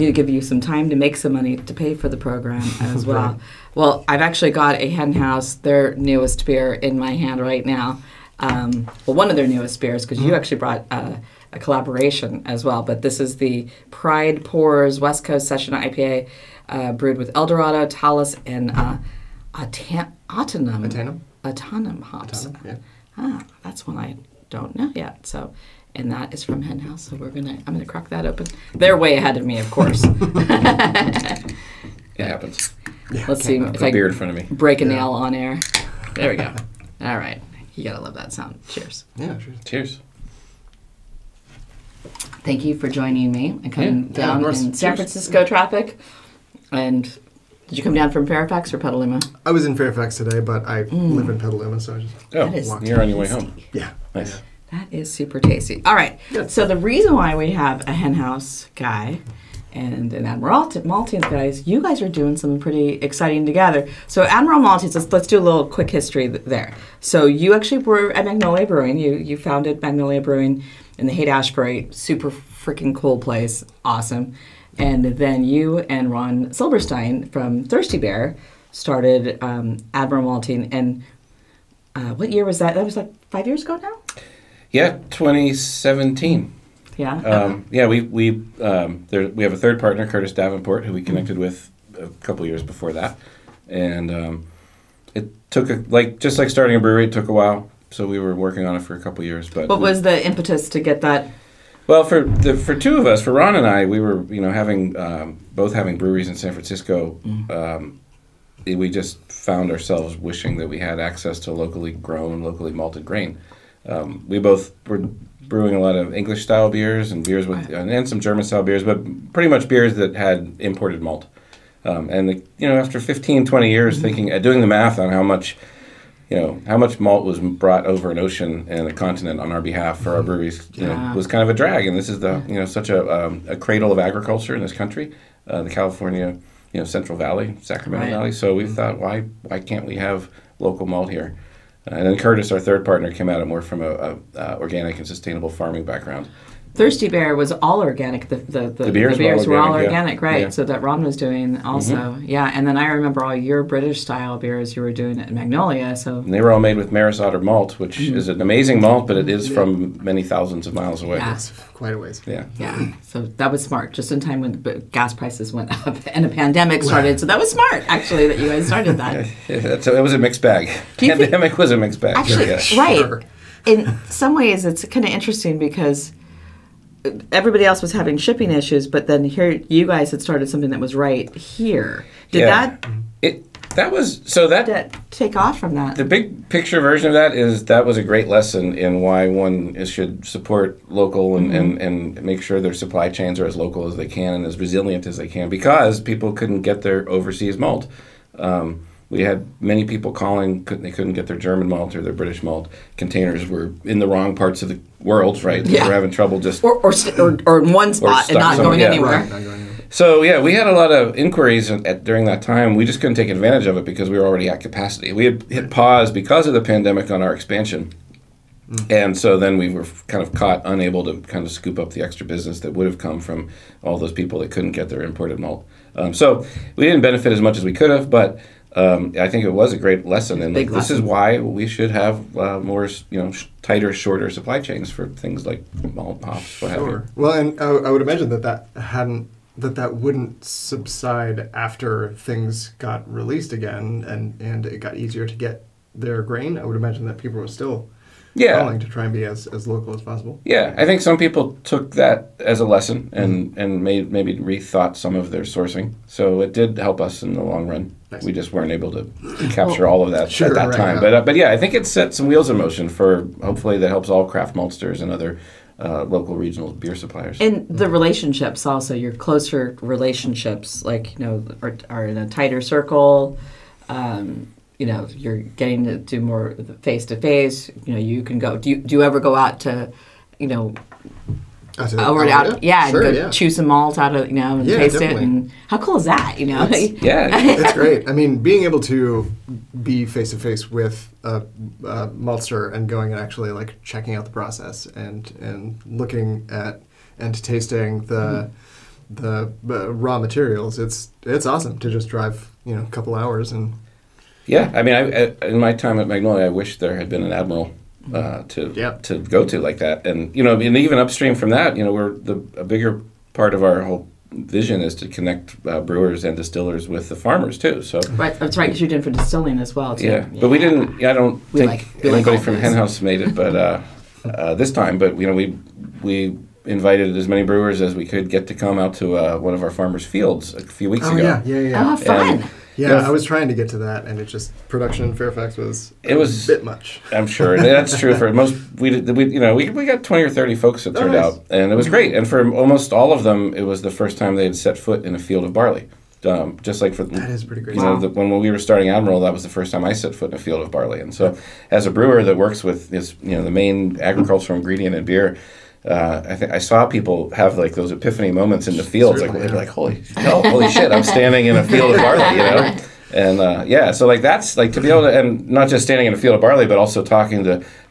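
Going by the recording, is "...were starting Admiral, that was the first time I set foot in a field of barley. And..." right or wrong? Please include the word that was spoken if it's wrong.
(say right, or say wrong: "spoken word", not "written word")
right.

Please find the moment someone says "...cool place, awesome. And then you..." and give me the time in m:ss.
1:12.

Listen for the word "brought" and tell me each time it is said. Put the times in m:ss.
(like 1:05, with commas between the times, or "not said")
0:10, 2:07.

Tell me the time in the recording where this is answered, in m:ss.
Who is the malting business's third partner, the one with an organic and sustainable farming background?
1:30.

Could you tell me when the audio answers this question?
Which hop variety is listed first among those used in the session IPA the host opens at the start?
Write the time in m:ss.
0:17.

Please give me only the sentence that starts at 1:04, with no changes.
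So Admiral Malting, let's, let's do a little quick history there.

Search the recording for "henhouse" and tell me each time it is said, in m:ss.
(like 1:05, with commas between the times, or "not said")
0:04, 0:26, 0:57, 5:22.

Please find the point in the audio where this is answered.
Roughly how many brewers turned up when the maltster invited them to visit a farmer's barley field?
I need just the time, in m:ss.
5:40.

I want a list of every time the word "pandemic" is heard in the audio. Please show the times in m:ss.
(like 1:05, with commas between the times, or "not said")
2:46, 2:50, 3:36.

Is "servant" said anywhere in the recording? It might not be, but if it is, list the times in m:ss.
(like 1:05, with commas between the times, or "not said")
not said.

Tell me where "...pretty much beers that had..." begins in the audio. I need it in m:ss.
1:59.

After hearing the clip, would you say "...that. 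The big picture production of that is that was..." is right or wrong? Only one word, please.
wrong.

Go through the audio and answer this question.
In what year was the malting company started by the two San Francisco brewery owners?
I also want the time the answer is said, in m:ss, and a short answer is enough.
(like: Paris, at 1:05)
2017, at 1:25.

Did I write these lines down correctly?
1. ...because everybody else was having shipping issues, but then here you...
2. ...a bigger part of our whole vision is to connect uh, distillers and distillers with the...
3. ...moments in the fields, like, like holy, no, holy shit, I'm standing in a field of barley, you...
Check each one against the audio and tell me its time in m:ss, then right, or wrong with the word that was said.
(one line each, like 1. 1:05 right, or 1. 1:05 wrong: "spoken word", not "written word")
1. 2:55 right
2. 5:12 wrong: "brewers", not "distillers"
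3. 5:58 right.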